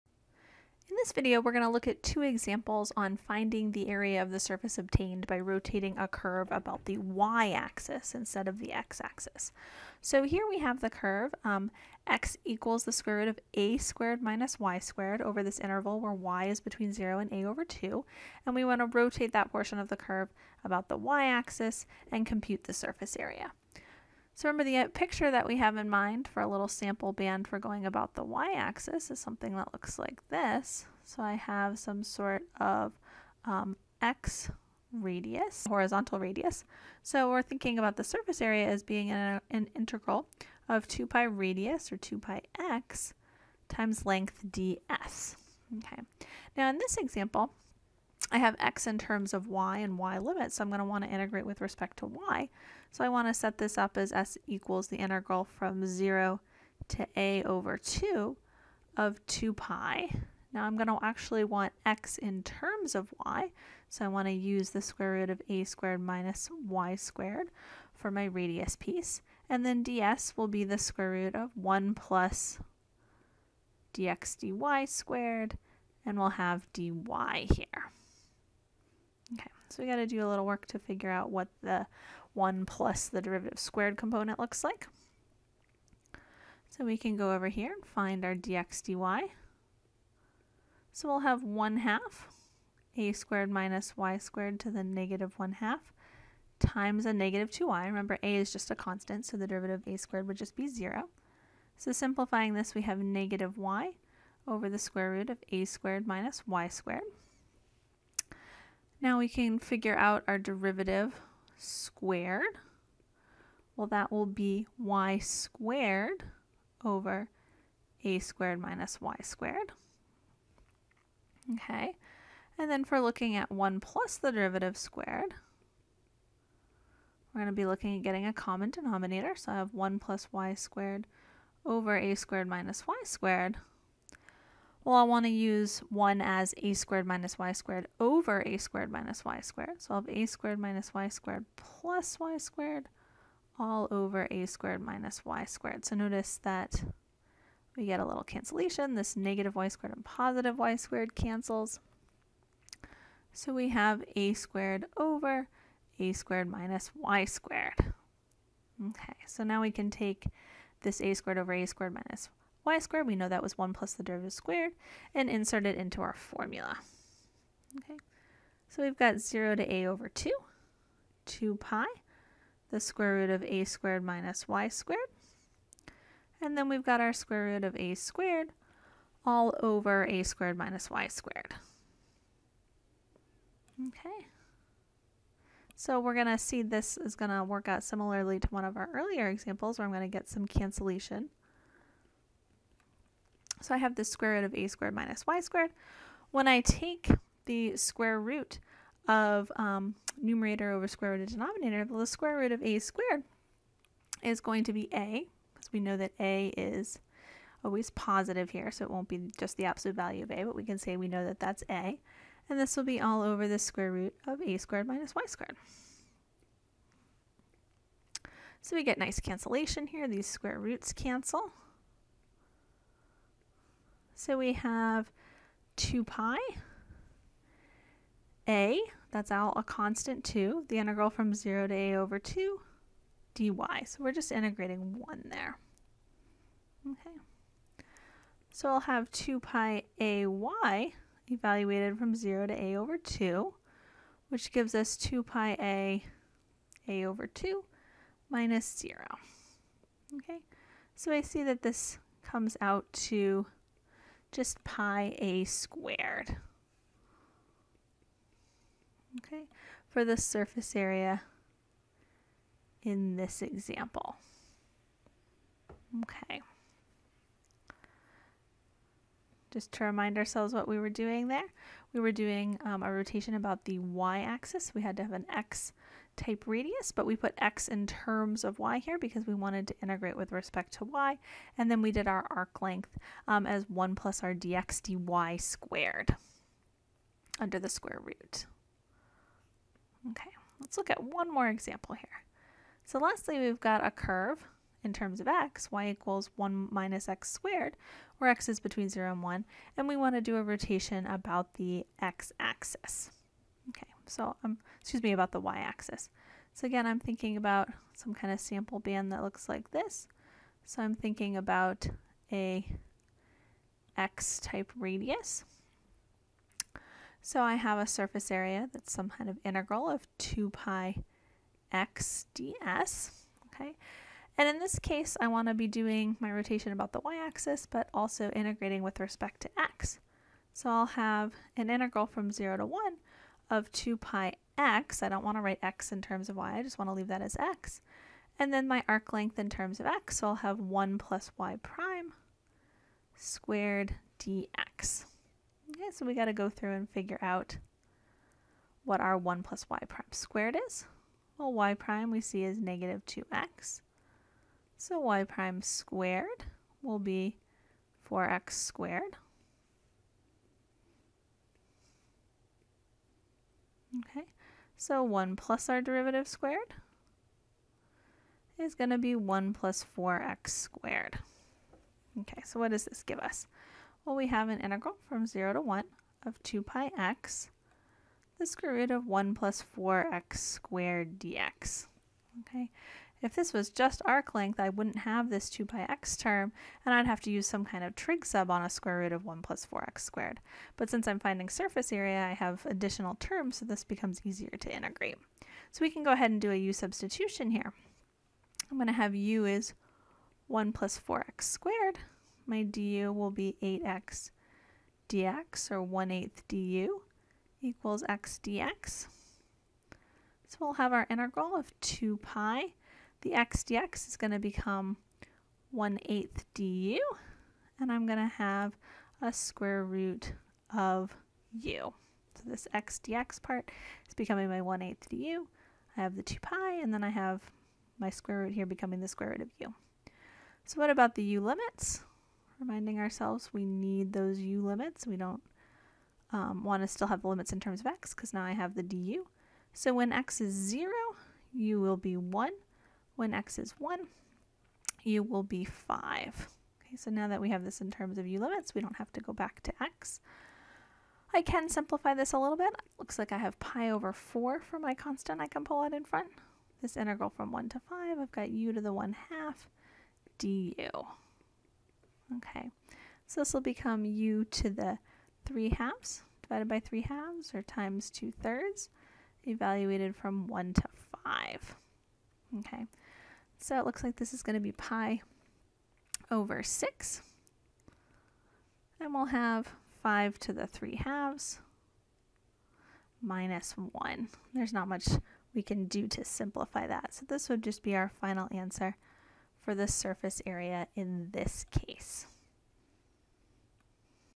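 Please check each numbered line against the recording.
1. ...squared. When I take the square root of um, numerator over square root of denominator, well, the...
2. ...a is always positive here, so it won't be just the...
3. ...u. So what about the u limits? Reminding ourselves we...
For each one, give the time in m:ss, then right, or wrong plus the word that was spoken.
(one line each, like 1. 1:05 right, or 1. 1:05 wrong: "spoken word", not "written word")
1. 3:15 right
2. 3:26 right
3. 7:09 right.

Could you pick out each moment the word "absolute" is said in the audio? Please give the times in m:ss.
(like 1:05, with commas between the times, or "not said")
3:29.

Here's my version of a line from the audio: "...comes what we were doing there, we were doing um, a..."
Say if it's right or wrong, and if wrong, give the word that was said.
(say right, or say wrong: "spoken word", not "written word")
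wrong: "ourselves", not "comes".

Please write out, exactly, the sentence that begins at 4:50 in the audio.
Okay, let's look at one more example here.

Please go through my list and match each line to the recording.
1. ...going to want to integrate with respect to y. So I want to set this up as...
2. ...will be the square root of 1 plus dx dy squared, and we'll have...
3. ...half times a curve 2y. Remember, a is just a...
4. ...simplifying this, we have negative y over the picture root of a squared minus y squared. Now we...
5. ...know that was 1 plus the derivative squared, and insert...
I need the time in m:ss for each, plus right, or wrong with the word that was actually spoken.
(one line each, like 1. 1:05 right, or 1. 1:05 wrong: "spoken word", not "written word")
1. 0:50 right
2. 1:10 right
3. 1:35 wrong: "negative", not "curve"
4. 1:41 wrong: "square", not "picture"
5. 2:43 right.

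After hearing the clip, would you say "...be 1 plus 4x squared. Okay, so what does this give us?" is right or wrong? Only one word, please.
right.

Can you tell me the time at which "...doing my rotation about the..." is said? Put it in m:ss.
5:25.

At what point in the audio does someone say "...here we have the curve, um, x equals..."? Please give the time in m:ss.
0:10.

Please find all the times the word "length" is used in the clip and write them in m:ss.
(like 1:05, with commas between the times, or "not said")
0:44, 4:42, 5:39, 6:24.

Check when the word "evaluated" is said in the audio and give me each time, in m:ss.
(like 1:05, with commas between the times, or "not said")
4:01, 7:49.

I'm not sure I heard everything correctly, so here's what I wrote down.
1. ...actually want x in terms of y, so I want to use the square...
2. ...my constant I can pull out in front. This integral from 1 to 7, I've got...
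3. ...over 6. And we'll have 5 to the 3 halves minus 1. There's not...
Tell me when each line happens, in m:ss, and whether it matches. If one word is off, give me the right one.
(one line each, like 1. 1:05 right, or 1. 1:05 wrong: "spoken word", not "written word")
1. 1:01 right
2. 7:34 wrong: "5", not "7"
3. 7:56 right.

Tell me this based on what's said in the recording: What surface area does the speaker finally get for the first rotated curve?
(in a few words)
πa².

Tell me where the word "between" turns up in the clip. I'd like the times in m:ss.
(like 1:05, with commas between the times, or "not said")
0:16, 4:58.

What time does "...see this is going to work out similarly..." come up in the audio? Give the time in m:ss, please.
3:06.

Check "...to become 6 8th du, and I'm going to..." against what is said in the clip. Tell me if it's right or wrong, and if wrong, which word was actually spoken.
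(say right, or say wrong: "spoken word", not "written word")
wrong: "1", not "6".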